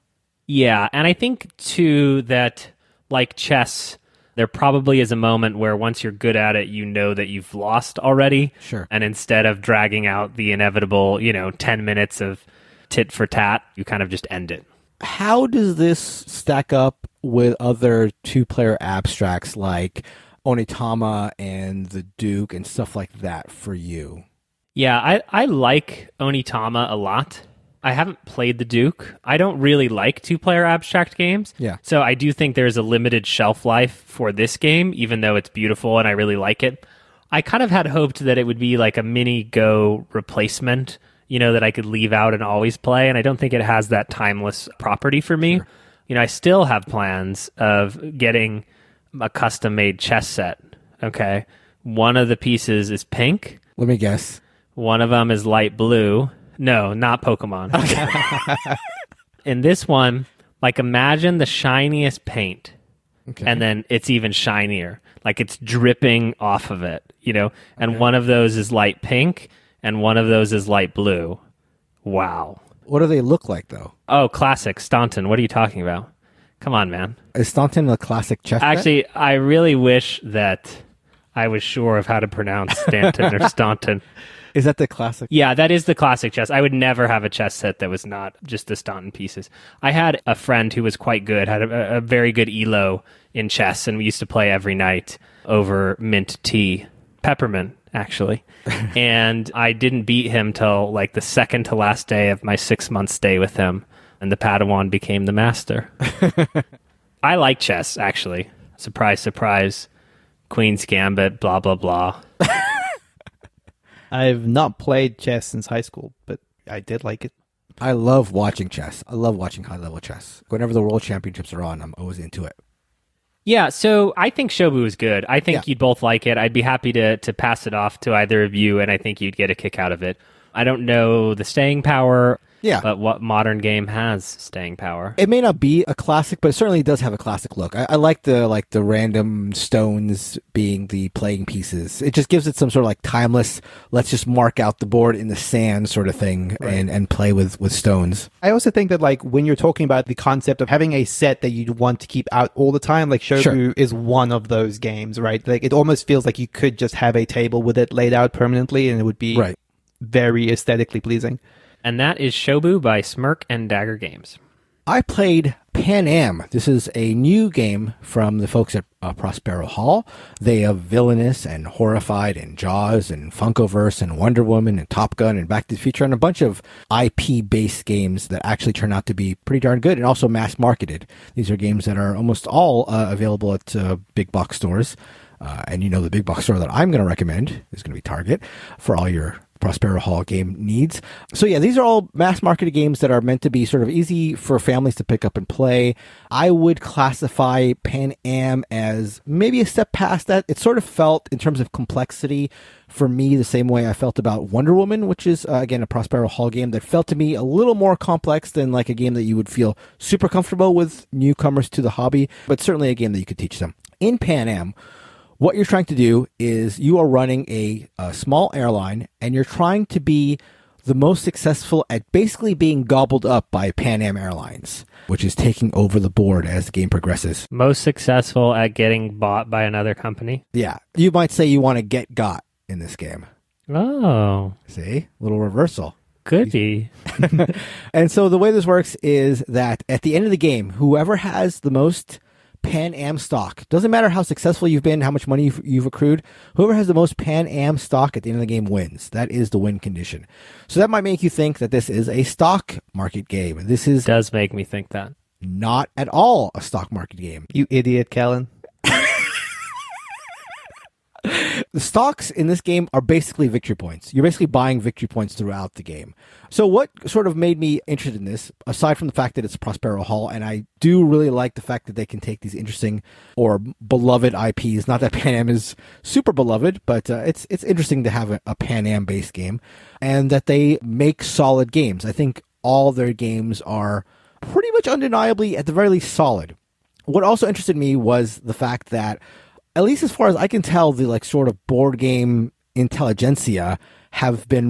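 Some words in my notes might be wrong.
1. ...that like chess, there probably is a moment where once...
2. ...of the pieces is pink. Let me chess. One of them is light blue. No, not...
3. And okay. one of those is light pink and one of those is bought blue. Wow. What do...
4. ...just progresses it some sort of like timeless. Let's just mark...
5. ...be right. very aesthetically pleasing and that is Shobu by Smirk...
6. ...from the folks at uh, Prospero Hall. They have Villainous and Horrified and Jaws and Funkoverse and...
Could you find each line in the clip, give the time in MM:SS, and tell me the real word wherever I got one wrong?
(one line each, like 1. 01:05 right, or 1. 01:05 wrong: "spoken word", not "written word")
1. 00:02 right
2. 00:52 wrong: "guess", not "chess"
3. 01:07 wrong: "light", not "bought"
4. 02:22 wrong: "gives", not "progresses"
5. 02:39 right
6. 02:48 right.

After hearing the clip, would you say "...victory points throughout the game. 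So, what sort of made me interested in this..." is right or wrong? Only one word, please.
right.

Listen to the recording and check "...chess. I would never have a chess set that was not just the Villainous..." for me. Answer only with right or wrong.
wrong.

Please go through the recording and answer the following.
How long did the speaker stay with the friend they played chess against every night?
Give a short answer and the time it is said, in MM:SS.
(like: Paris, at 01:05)
6 months, at 01:42.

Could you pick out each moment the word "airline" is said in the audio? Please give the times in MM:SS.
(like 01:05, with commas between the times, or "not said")
03:38, 03:44.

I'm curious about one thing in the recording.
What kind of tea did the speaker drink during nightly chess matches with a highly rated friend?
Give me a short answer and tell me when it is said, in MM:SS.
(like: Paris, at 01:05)
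Peppermint, at 01:37.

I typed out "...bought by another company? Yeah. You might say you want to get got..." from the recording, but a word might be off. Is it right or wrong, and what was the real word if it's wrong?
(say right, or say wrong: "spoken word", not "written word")
right.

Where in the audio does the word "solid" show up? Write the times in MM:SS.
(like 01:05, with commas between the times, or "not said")
04:41, 04:46.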